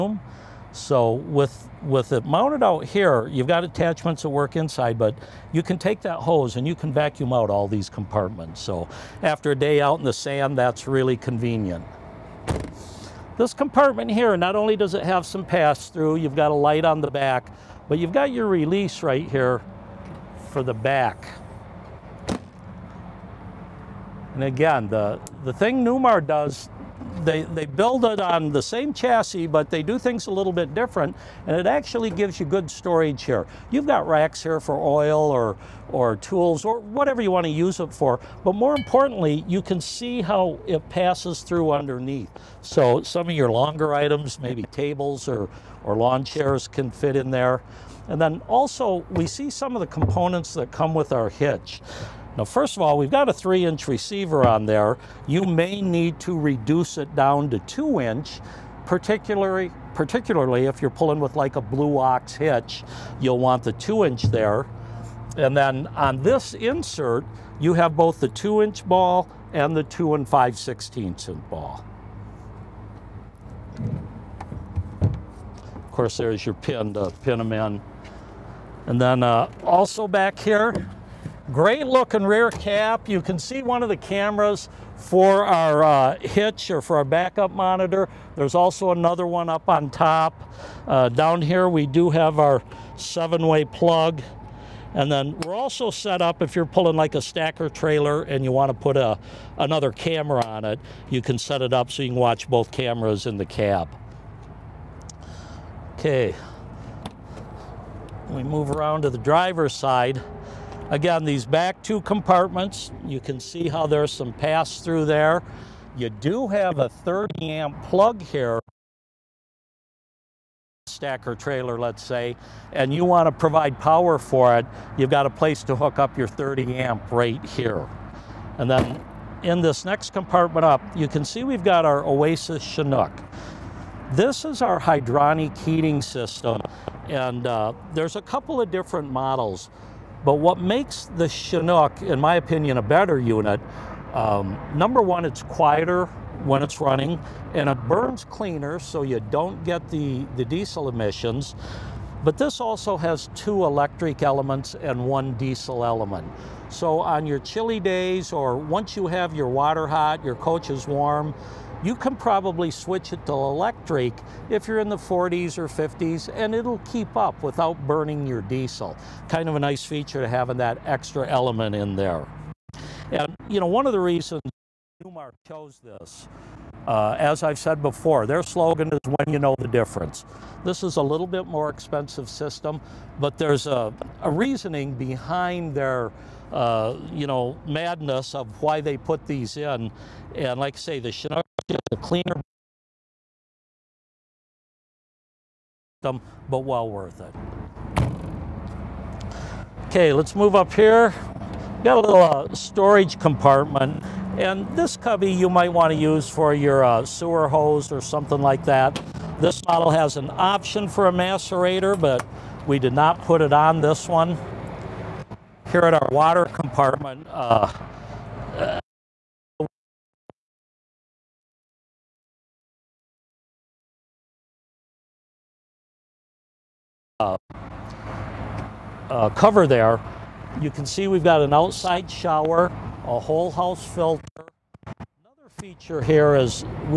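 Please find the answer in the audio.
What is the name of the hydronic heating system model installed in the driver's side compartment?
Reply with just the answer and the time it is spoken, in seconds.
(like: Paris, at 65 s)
Oasis Chinook, at 132 s.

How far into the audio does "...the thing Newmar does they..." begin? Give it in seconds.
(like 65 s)
25 s.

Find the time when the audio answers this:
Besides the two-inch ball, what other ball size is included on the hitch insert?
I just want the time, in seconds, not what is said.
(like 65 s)
69 s.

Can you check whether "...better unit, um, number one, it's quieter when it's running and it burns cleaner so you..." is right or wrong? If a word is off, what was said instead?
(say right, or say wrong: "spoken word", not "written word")
right.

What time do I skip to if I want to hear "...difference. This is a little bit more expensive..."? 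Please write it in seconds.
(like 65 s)
179 s.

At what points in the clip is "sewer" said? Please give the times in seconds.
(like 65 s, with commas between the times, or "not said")
207 s.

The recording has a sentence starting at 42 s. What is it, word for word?
So some of your longer items, maybe tables or, or lawn chairs can fit in there.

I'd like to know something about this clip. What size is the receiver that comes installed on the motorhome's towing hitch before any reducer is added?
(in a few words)
3 inch.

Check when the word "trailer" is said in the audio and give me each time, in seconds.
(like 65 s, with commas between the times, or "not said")
97 s, 121 s.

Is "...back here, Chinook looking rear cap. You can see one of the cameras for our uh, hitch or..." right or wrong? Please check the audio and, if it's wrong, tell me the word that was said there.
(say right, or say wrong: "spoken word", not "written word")
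wrong: "Great", not "Chinook".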